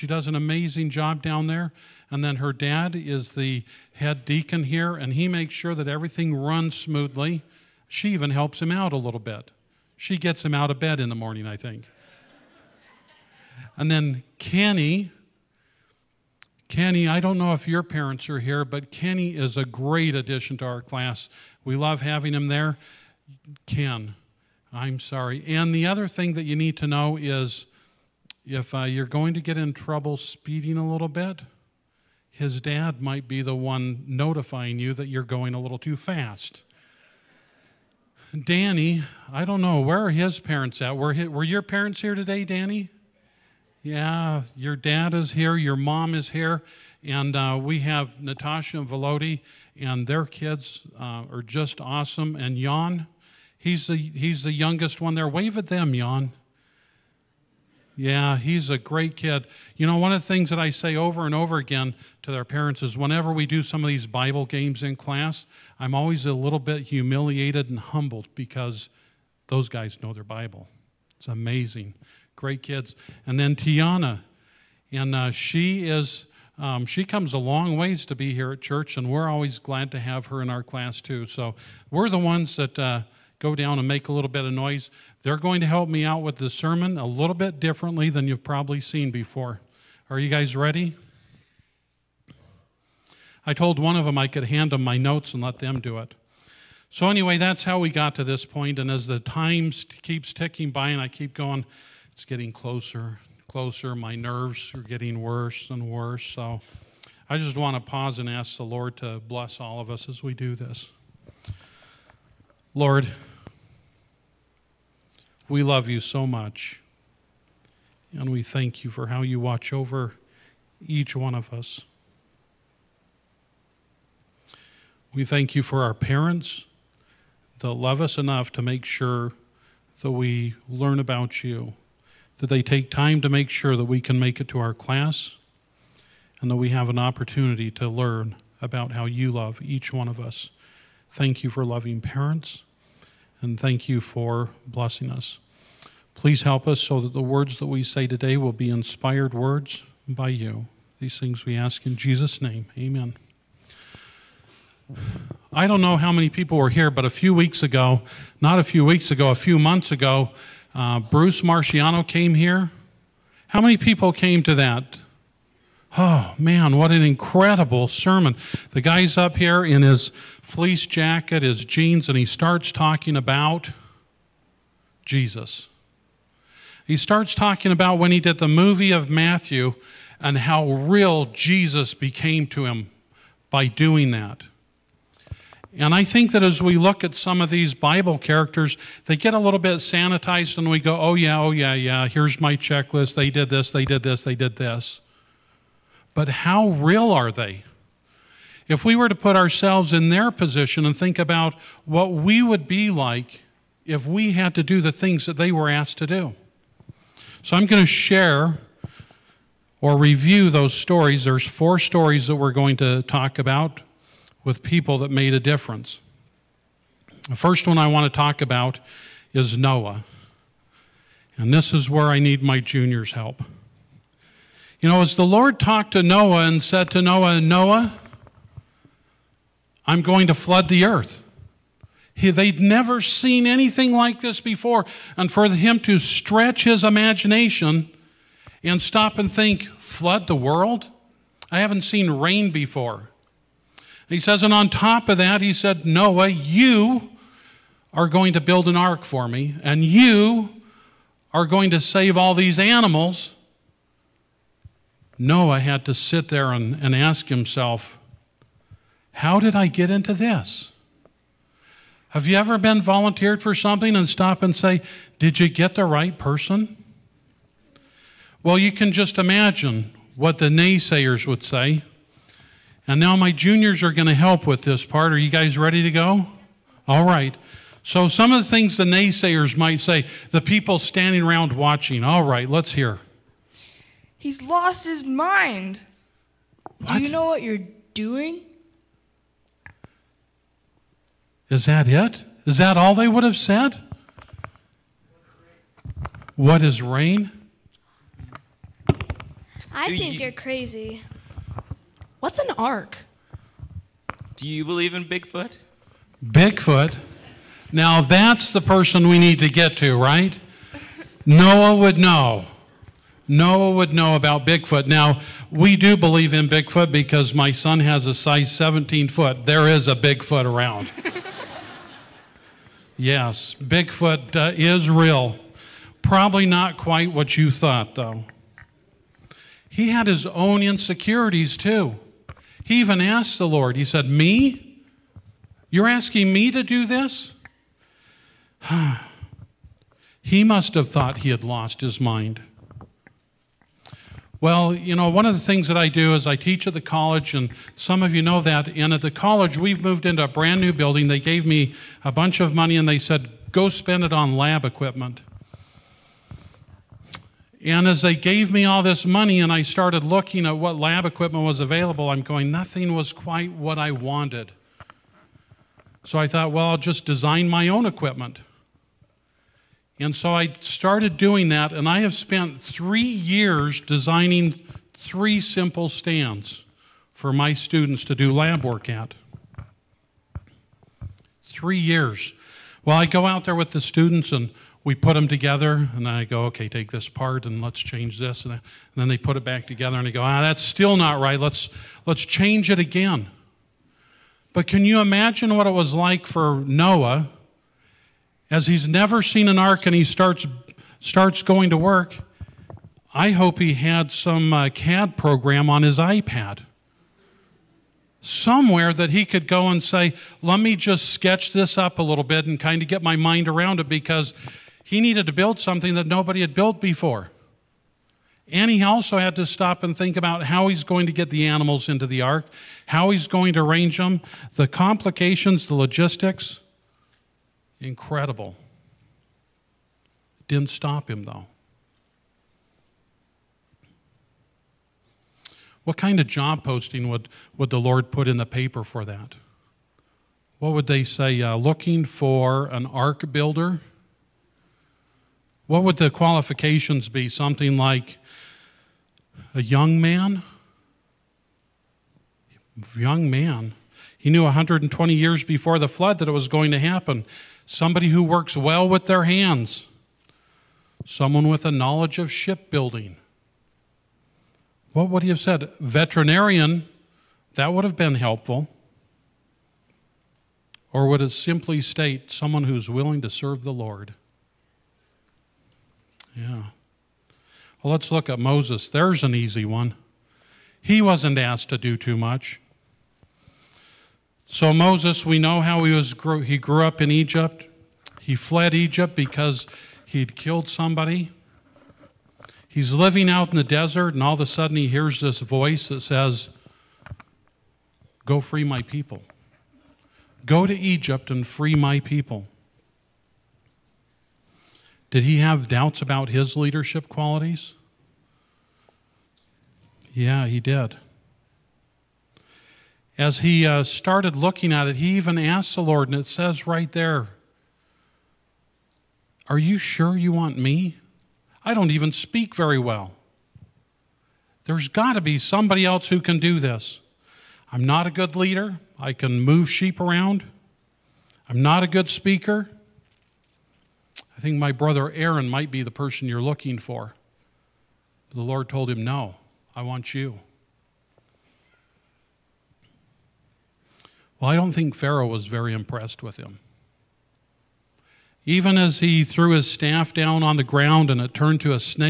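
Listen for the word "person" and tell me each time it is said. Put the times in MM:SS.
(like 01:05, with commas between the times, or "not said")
04:26, 05:08, 08:55.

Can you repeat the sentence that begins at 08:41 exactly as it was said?
I don't even speak very well.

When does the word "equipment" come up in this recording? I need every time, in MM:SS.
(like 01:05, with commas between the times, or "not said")
05:54, 06:01, 06:07.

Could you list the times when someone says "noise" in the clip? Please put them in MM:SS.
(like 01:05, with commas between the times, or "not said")
01:24.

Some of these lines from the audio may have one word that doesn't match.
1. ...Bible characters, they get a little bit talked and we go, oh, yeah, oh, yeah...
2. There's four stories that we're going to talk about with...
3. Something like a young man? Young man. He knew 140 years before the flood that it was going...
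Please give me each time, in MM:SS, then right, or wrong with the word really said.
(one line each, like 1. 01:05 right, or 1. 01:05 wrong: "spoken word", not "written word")
1. 03:07 wrong: "sanitized", not "talked"
2. 03:31 right
3. 07:27 wrong: "120", not "140".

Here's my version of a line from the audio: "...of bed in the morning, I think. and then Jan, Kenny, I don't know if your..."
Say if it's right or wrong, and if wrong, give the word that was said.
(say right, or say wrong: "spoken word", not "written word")
wrong: "Kenny", not "Jan".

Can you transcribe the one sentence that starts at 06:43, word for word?
I hope he had some uh, CAD program on his iPad.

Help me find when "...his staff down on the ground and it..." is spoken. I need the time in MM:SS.
09:09.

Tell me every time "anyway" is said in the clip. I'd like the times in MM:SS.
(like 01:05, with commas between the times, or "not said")
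01:37.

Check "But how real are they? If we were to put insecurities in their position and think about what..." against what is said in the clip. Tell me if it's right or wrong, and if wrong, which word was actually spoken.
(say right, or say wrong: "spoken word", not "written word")
wrong: "ourselves", not "insecurities".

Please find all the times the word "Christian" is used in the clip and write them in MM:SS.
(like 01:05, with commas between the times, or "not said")
not said.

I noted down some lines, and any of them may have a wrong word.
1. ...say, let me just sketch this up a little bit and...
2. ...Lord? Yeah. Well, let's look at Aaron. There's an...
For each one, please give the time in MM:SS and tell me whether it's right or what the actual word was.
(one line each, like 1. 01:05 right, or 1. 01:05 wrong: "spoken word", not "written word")
1. 06:49 right
2. 07:53 wrong: "Moses", not "Aaron".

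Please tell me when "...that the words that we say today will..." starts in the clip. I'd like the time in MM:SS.
02:26.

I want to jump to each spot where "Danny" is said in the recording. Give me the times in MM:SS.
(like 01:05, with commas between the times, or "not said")
00:38, 00:42.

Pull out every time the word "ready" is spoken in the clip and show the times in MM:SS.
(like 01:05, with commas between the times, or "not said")
01:30, 04:35.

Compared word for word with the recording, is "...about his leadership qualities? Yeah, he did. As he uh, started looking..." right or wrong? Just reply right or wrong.
right.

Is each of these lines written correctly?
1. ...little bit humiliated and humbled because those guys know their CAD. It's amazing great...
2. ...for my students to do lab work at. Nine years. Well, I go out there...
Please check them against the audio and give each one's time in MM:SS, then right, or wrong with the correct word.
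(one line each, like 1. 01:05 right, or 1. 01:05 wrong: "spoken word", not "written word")
1. 01:06 wrong: "Bible", not "CAD"
2. 06:17 wrong: "Three", not "Nine".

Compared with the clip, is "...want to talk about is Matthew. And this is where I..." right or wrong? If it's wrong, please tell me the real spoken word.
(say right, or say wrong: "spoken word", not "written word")
wrong: "Noah", not "Matthew".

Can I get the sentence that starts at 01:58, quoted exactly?
And we thank you for how you watch over each one of us.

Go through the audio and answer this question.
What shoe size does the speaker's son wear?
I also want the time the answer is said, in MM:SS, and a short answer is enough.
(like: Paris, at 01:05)
17, at 05:18.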